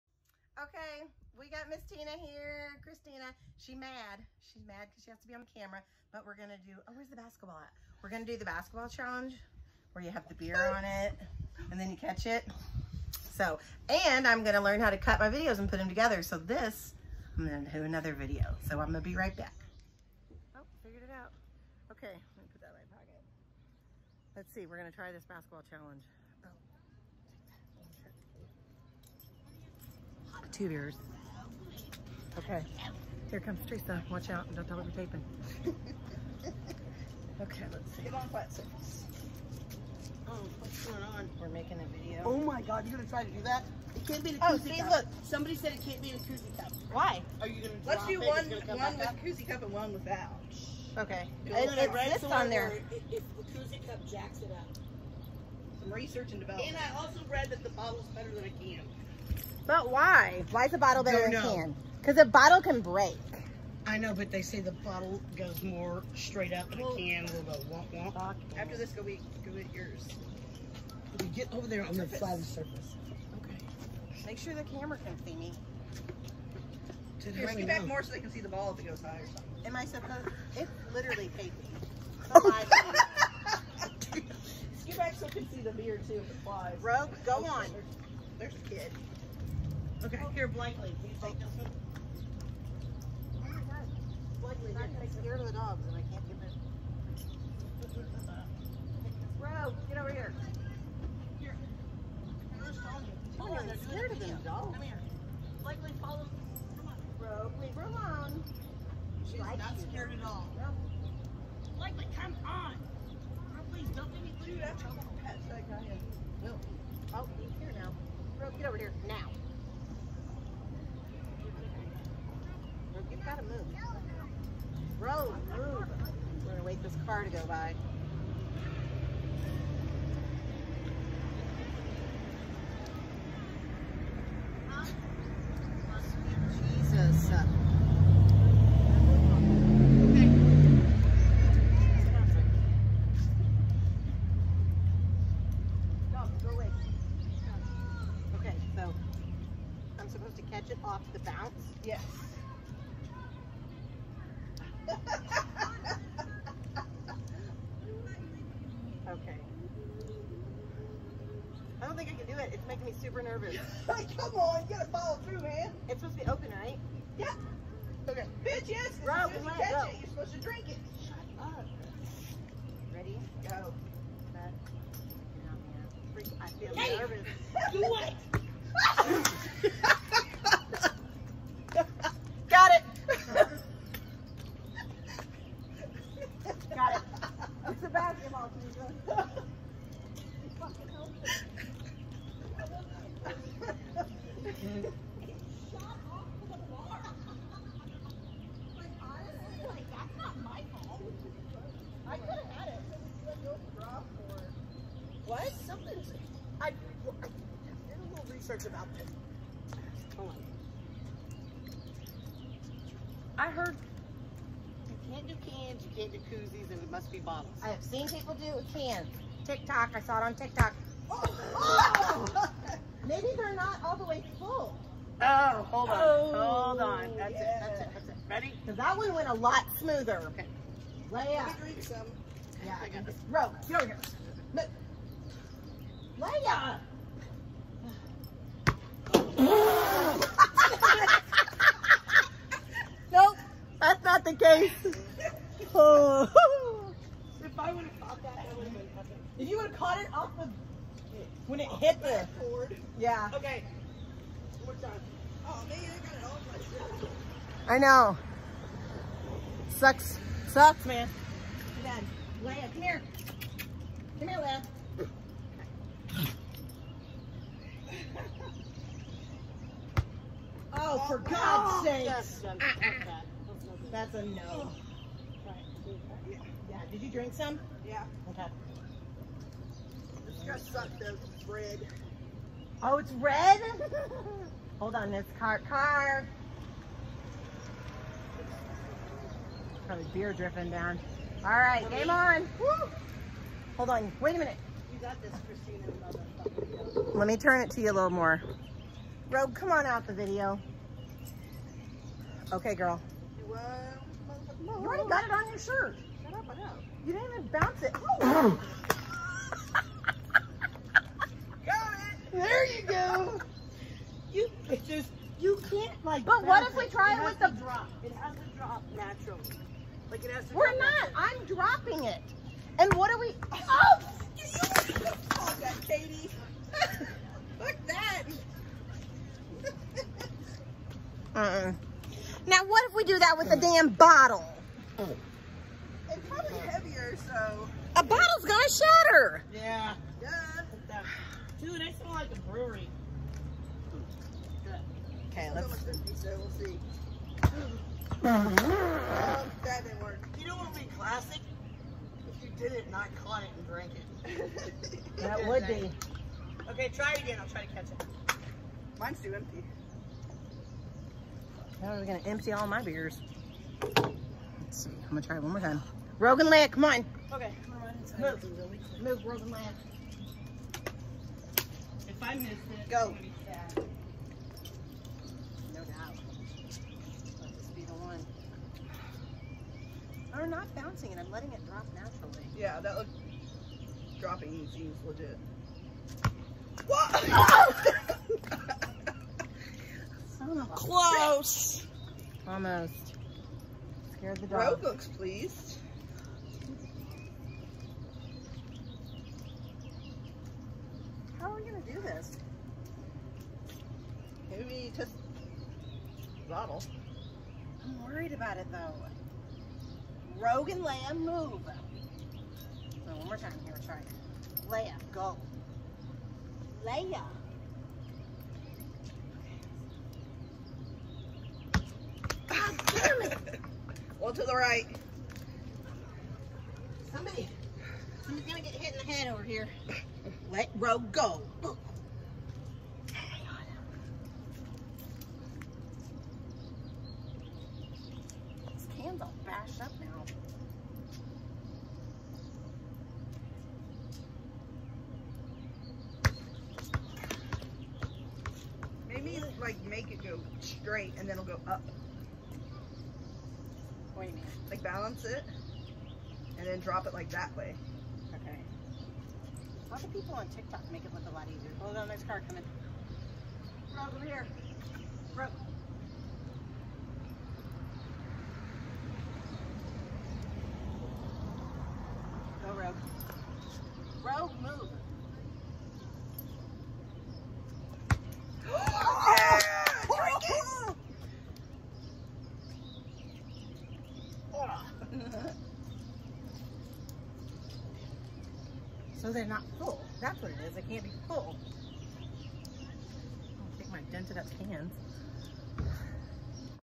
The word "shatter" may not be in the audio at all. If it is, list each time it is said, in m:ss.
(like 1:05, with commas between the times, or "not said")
5:38.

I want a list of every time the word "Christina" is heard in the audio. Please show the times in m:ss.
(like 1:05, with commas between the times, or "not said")
0:02, 4:55.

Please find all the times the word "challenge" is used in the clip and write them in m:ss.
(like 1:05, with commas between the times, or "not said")
0:08, 0:25.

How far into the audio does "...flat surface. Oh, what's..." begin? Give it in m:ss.
0:38.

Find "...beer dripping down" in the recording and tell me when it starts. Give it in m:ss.
4:50.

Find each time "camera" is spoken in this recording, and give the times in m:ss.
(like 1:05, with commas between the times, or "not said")
0:05, 1:14.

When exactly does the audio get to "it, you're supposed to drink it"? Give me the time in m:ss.
2:49.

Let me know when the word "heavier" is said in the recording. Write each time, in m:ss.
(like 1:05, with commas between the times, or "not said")
5:36.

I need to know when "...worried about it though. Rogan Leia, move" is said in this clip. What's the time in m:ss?
6:48.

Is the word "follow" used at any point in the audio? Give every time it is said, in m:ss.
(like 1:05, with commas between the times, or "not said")
1:46, 2:44.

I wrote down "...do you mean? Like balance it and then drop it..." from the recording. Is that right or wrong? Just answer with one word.
right.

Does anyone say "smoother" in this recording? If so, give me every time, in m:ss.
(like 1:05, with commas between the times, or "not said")
3:49.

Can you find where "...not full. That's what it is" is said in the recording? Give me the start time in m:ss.
8:09.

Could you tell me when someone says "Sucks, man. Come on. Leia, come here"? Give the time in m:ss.
4:20.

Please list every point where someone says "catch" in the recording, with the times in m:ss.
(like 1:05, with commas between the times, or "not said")
0:11, 2:49, 5:57.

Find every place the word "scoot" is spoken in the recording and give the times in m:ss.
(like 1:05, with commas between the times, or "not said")
1:17, 1:24.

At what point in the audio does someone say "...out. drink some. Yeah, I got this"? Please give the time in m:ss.
3:51.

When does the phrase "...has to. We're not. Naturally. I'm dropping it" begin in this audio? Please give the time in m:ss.
5:20.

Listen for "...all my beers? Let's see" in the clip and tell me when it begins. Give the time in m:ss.
6:02.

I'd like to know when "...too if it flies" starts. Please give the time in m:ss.
1:26.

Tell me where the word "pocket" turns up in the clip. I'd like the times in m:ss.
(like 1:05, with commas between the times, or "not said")
0:22.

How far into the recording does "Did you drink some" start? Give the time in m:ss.
4:36.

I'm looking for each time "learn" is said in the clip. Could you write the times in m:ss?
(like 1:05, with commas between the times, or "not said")
0:14.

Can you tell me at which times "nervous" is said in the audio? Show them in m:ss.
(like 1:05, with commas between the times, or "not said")
2:43, 2:56.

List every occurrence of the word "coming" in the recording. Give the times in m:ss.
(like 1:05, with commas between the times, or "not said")
7:42.